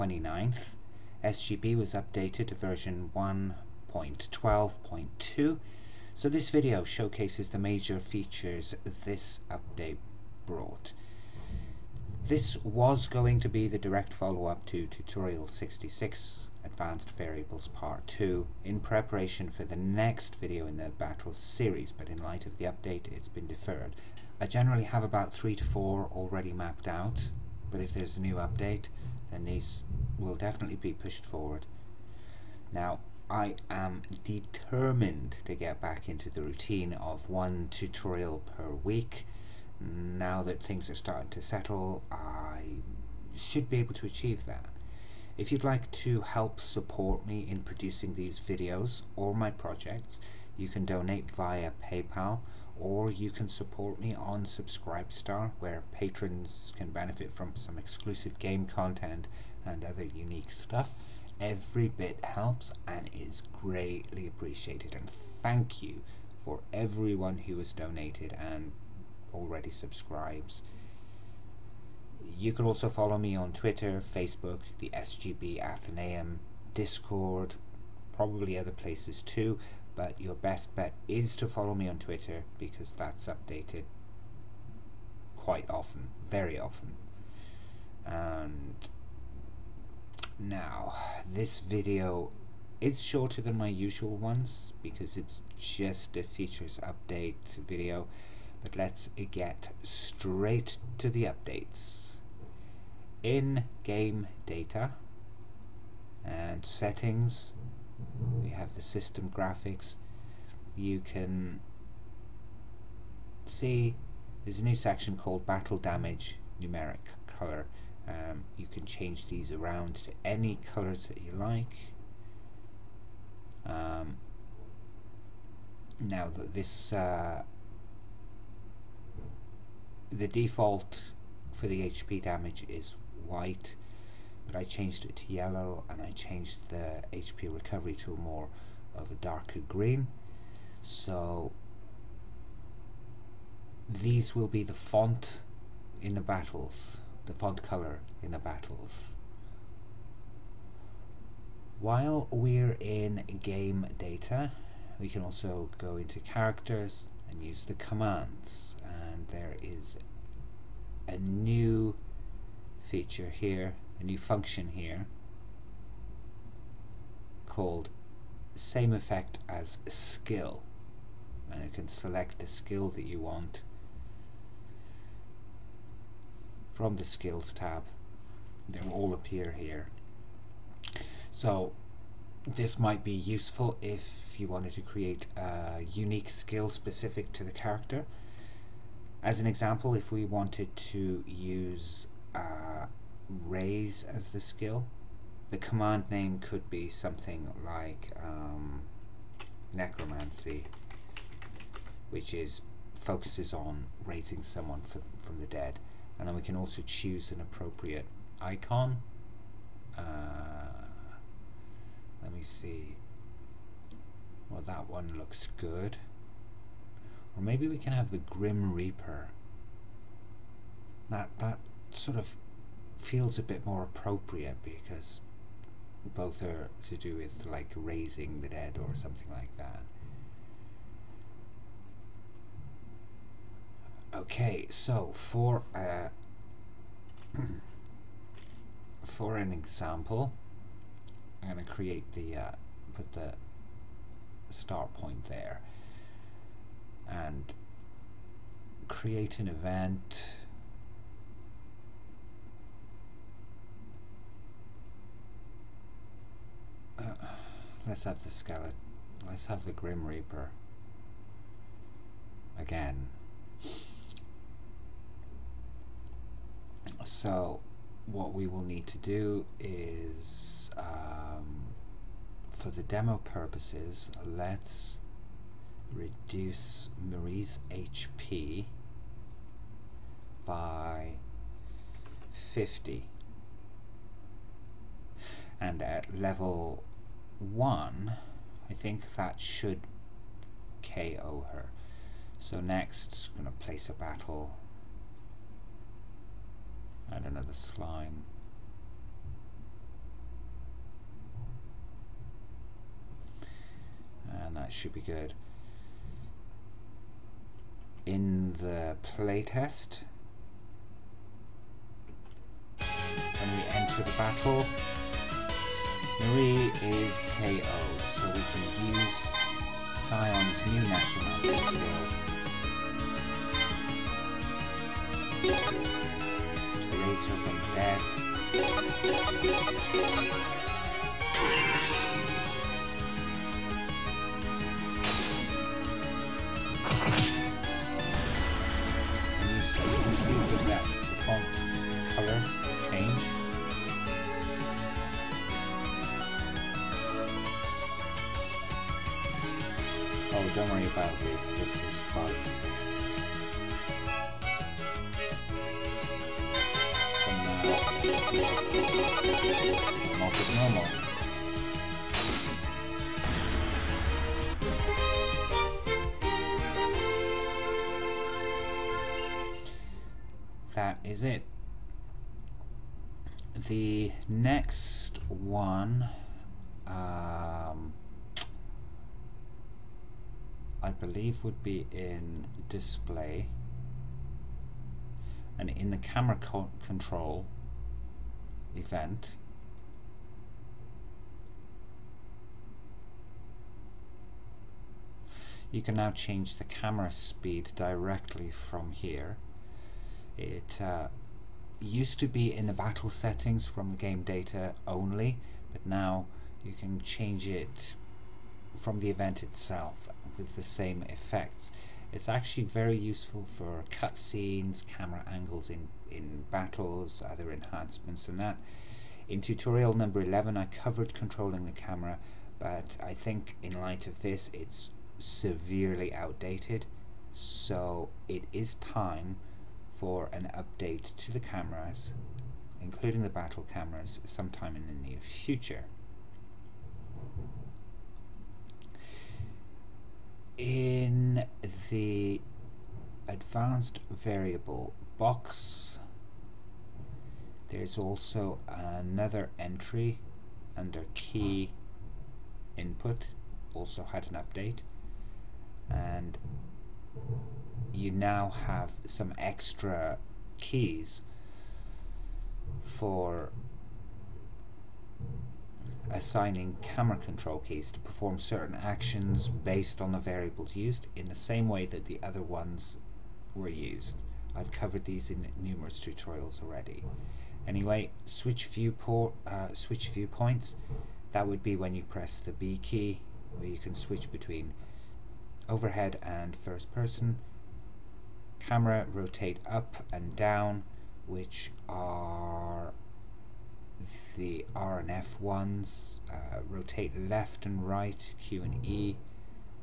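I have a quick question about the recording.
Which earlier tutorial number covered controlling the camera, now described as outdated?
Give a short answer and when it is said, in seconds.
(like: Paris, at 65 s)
11, at 420 s.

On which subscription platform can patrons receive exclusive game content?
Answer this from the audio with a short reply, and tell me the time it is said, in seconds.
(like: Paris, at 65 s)
Subscribestar, at 54 s.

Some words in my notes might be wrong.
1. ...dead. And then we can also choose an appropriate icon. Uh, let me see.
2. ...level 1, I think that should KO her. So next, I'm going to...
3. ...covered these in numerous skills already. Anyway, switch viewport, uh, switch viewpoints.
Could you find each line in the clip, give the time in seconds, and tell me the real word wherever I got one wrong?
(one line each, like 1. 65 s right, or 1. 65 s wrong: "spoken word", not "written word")
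1. 205 s right
2. 286 s right
3. 474 s wrong: "tutorials", not "skills".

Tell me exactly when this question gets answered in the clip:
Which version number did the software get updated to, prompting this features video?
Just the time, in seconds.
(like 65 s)
3 s.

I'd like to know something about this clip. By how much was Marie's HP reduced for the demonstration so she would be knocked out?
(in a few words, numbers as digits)
50.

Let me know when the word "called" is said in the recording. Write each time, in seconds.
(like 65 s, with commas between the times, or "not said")
115 s, 167 s.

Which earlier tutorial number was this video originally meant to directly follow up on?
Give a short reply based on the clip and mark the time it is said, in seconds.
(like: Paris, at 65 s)
Tutorial 66, at 14 s.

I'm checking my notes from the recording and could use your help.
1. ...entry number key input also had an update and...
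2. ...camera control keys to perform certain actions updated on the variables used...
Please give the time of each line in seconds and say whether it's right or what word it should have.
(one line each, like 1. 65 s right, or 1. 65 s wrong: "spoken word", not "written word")
1. 449 s wrong: "under", not "number"
2. 466 s wrong: "based", not "updated".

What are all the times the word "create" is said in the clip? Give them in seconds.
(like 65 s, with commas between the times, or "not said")
184 s, 241 s, 248 s.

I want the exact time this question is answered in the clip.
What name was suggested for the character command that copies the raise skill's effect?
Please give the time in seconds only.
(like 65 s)
199 s.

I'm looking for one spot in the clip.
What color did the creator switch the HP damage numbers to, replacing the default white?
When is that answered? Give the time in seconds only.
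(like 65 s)
135 s.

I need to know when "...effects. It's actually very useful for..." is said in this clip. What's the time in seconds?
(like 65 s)
411 s.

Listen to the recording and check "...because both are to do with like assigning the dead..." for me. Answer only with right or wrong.
wrong.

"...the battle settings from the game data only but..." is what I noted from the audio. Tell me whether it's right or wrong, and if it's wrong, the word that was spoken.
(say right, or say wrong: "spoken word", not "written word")
right.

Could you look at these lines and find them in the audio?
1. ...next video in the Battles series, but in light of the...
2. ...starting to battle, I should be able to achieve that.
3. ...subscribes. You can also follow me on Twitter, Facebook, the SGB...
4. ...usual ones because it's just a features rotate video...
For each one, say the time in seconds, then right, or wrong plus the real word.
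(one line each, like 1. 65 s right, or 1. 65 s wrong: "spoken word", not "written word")
1. 19 s right
2. 40 s wrong: "settle", not "battle"
3. 69 s right
4. 93 s wrong: "update", not "rotate".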